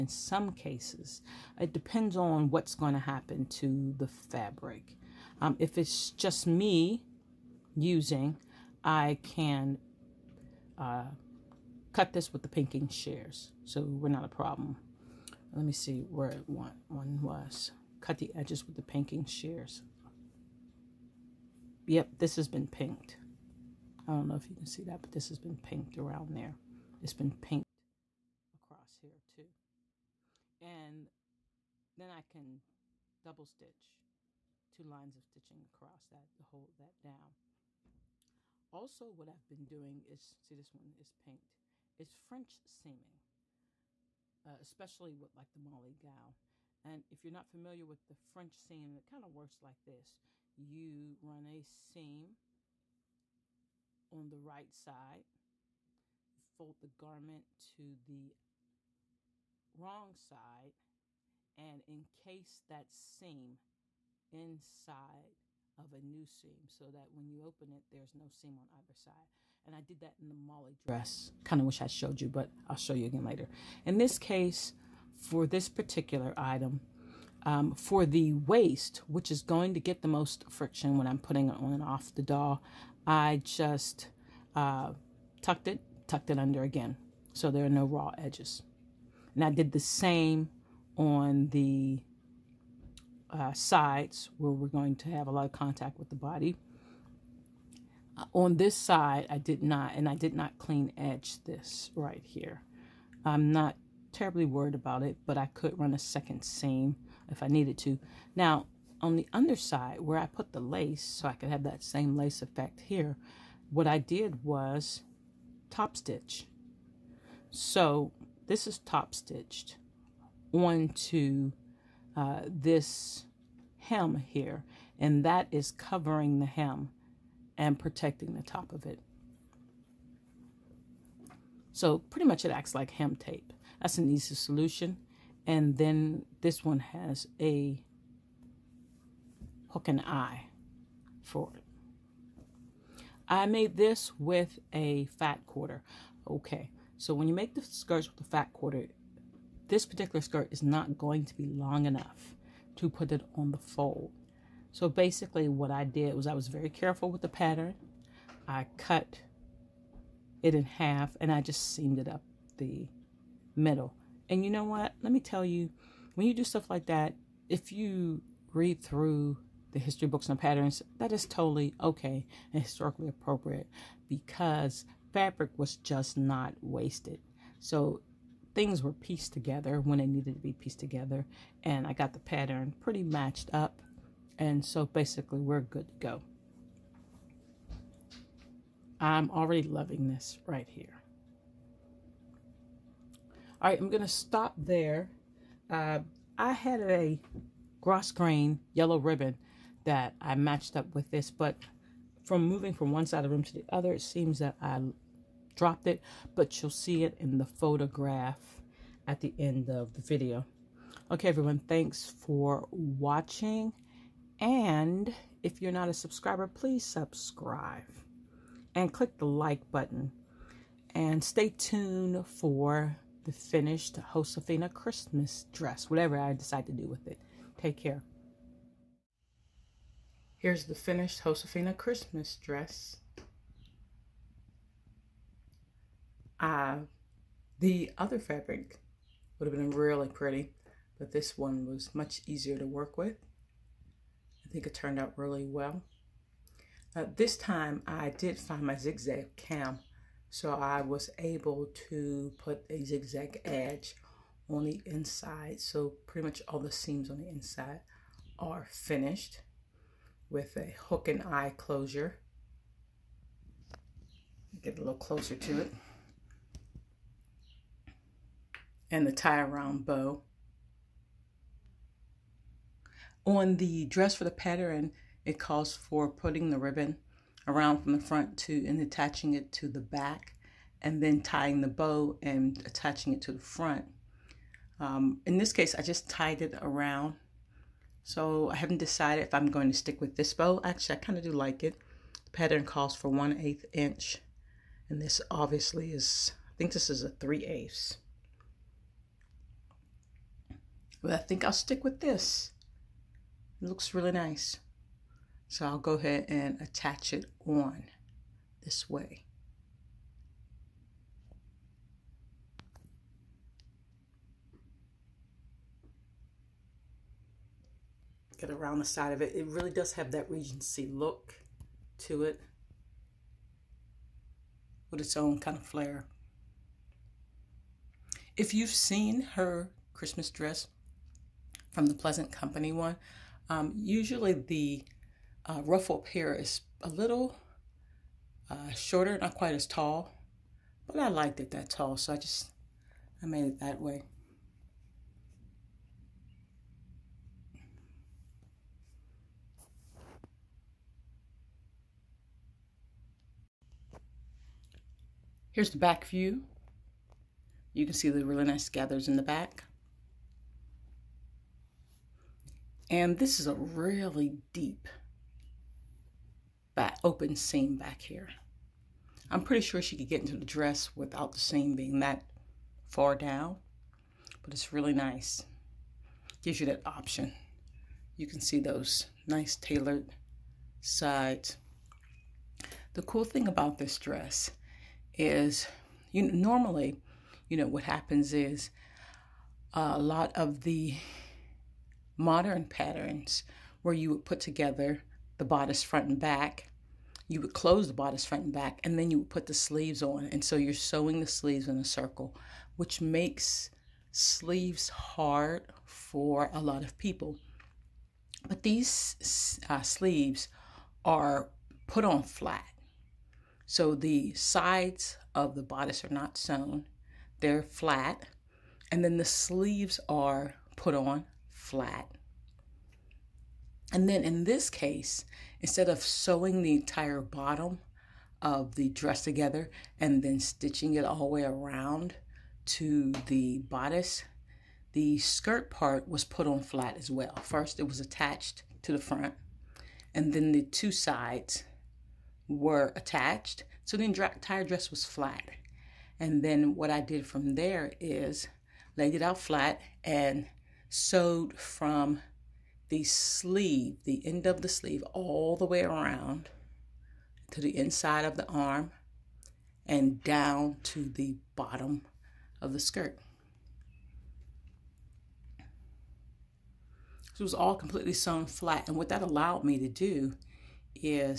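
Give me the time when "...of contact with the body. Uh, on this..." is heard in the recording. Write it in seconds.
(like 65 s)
95 s.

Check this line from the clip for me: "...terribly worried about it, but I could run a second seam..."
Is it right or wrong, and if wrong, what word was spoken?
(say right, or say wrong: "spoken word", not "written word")
right.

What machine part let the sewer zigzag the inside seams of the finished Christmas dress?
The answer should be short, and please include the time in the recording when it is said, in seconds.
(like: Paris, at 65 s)
zigzag cam, at 248 s.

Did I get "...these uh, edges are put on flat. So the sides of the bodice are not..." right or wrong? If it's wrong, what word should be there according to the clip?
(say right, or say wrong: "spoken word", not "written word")
wrong: "sleeves", not "edges".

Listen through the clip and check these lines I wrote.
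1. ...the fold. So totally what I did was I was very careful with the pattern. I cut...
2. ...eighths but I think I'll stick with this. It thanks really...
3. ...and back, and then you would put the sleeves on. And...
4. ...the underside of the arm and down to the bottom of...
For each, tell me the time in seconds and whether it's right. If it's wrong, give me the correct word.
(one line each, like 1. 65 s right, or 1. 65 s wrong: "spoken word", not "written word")
1. 153 s wrong: "basically", not "totally"
2. 297 s wrong: "looks", not "thanks"
3. 398 s right
4. 457 s wrong: "inside", not "underside".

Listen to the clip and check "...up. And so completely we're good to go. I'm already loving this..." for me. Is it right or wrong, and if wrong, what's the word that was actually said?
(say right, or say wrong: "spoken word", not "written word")
wrong: "basically", not "completely".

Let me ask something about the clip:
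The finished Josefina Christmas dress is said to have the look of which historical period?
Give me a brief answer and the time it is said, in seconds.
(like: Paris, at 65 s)
Regency, at 320 s.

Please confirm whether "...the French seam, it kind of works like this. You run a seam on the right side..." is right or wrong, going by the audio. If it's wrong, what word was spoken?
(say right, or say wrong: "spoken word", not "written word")
right.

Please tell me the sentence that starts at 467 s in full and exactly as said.
So it was all completely sewn flat.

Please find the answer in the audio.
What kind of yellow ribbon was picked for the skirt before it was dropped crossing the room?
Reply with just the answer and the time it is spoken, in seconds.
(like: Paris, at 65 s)
grosgrain, at 197 s.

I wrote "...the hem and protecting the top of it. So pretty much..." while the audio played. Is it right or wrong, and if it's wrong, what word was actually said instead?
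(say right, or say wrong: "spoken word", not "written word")
right.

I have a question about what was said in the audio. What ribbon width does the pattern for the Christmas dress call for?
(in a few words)
1/8 inch.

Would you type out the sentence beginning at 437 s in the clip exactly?
First, it was attached to the front, and then the two sides were attached.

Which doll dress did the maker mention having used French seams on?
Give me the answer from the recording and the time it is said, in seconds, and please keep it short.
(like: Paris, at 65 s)
the Molly dress, at 70 s.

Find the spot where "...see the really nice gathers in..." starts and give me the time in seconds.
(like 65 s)
357 s.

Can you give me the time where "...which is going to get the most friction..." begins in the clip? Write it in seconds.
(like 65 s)
79 s.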